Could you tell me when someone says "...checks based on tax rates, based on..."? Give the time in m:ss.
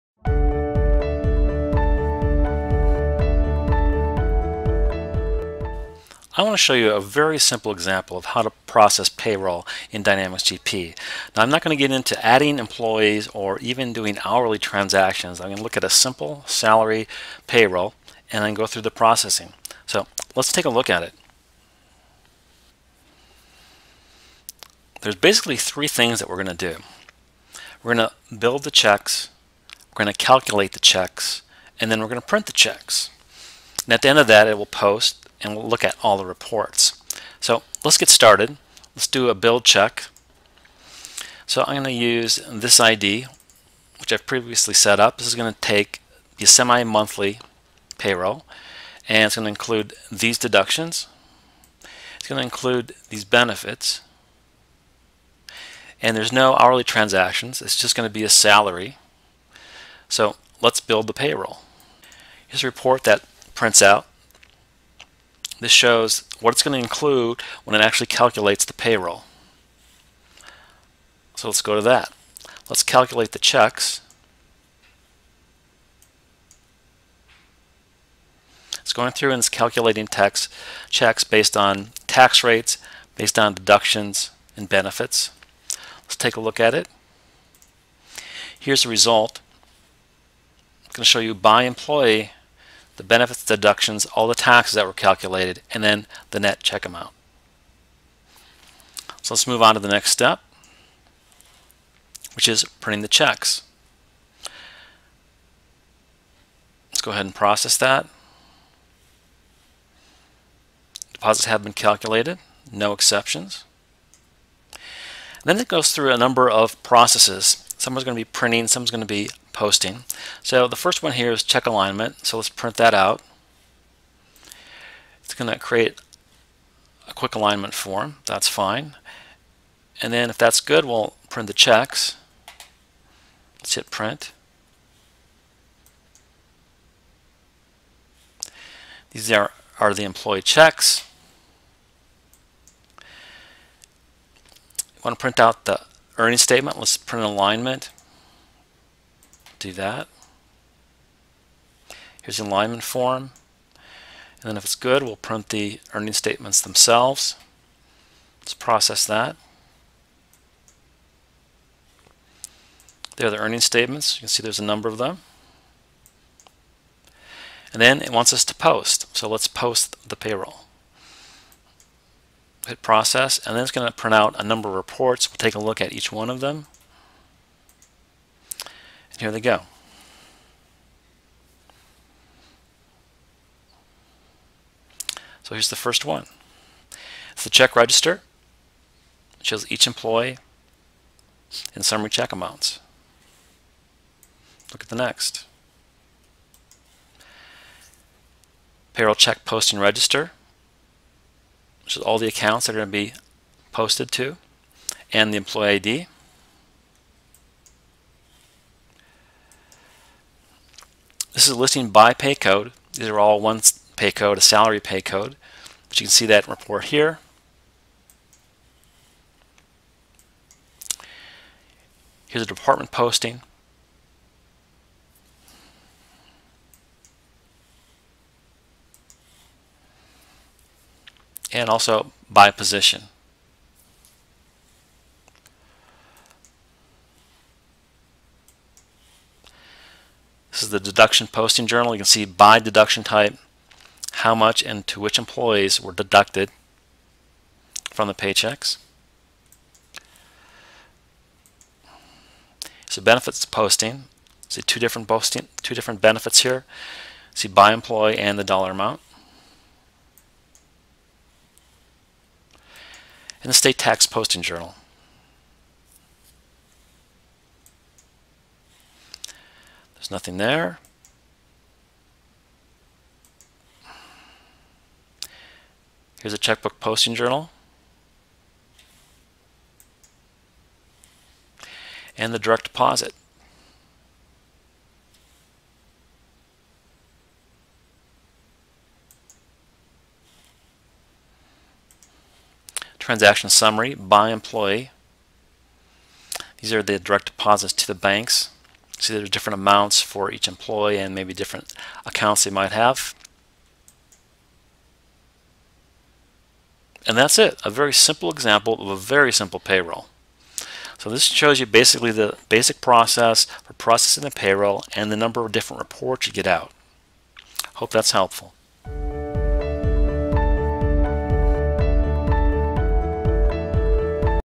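1:20.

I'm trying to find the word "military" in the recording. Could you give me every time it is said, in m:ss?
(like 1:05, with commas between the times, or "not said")
not said.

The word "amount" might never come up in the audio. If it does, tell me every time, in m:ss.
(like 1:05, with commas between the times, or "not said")
1:36, 3:12, 4:18, 4:59.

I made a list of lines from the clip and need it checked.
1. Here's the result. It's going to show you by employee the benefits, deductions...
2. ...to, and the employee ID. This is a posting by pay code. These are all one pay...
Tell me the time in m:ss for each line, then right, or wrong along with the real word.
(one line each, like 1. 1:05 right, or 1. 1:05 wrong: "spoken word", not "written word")
1. 1:28 right
2. 3:24 wrong: "listing", not "posting".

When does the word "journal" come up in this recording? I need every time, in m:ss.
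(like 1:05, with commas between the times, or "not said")
4:01, 4:24, 4:37.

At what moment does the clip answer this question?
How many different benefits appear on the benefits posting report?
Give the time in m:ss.
4:15.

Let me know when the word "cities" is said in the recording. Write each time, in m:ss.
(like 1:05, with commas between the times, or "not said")
not said.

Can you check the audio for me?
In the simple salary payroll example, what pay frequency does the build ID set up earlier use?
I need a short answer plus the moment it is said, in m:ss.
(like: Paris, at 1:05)
Semi-monthly, at 0:46.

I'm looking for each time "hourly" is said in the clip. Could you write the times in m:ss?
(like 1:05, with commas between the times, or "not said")
0:14, 0:56.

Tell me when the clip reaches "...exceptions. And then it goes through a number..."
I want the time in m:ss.
1:52.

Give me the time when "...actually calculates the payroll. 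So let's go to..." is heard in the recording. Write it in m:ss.
1:07.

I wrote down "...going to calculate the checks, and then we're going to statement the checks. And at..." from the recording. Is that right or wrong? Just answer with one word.
wrong.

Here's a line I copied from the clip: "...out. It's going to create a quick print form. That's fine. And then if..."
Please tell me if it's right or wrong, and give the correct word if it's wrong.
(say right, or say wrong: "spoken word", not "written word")
wrong: "alignment", not "print".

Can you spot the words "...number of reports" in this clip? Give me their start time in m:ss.
2:54.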